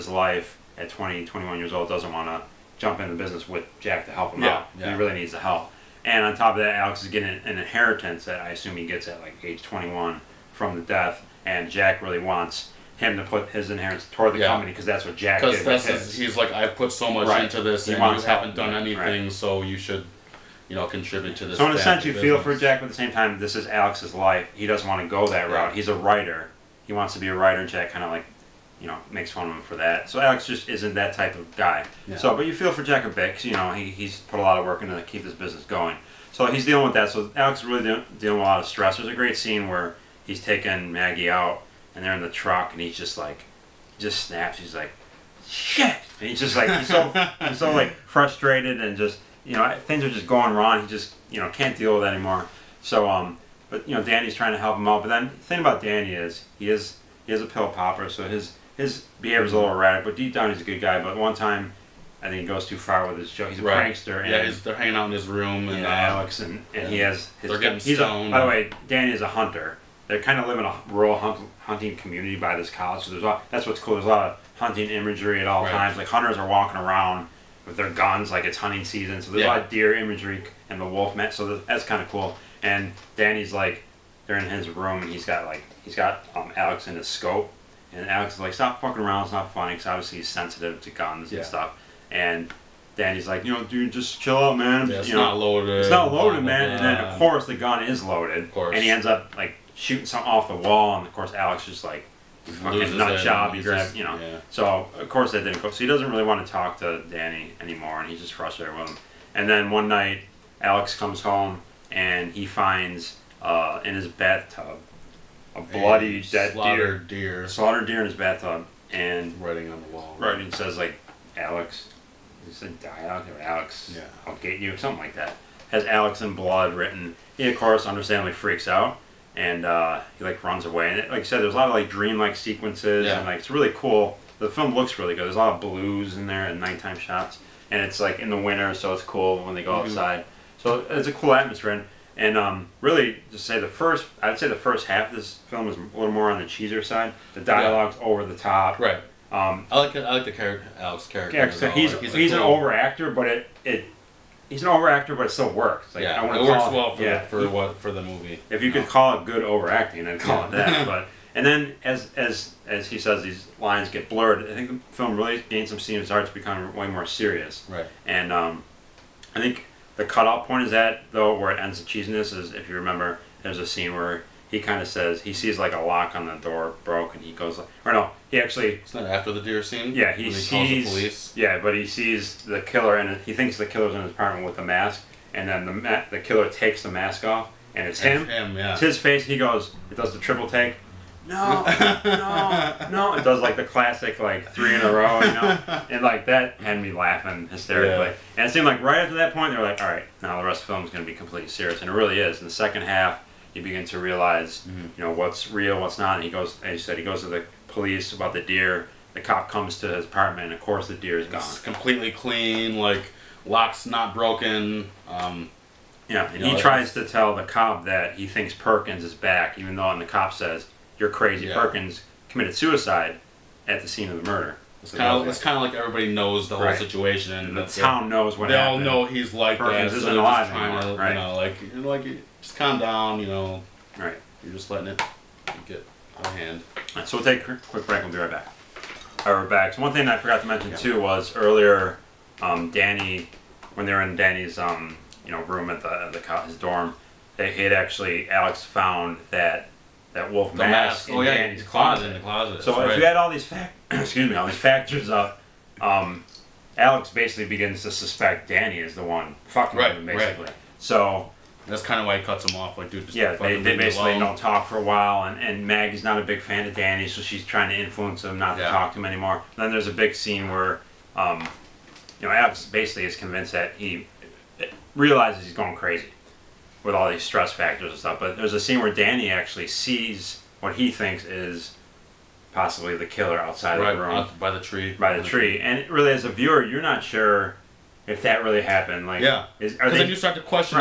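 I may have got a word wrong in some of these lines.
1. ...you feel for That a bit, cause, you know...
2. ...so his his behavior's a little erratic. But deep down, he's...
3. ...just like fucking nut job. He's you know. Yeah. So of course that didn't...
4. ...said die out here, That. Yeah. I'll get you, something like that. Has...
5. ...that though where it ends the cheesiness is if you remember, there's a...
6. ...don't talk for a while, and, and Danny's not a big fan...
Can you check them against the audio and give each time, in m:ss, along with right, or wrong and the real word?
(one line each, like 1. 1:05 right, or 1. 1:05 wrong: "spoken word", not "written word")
1. 0:32 wrong: "Jack", not "That"
2. 0:58 right
3. 1:41 right
4. 2:02 wrong: "Alex", not "That"
5. 2:50 right
6. 4:24 wrong: "Maggie", not "Danny".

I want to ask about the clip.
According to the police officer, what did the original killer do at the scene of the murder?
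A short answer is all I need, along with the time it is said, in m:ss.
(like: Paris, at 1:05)
Committed suicide, at 3:42.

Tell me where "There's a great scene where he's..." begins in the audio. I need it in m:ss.
0:38.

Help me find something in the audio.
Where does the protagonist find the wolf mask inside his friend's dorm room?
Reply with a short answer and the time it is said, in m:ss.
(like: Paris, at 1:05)
In the closet, at 4:12.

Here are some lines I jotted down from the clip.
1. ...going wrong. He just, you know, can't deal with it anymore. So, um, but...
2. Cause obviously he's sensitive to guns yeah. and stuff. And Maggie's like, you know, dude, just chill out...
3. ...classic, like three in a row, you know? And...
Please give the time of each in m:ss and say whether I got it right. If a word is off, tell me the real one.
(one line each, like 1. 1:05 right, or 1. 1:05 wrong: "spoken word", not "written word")
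1. 0:50 right
2. 1:29 wrong: "Danny", not "Maggie"
3. 3:13 right.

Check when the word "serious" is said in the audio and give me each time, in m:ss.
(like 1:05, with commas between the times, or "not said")
2:47, 3:21.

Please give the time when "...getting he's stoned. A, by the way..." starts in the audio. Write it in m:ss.
1:07.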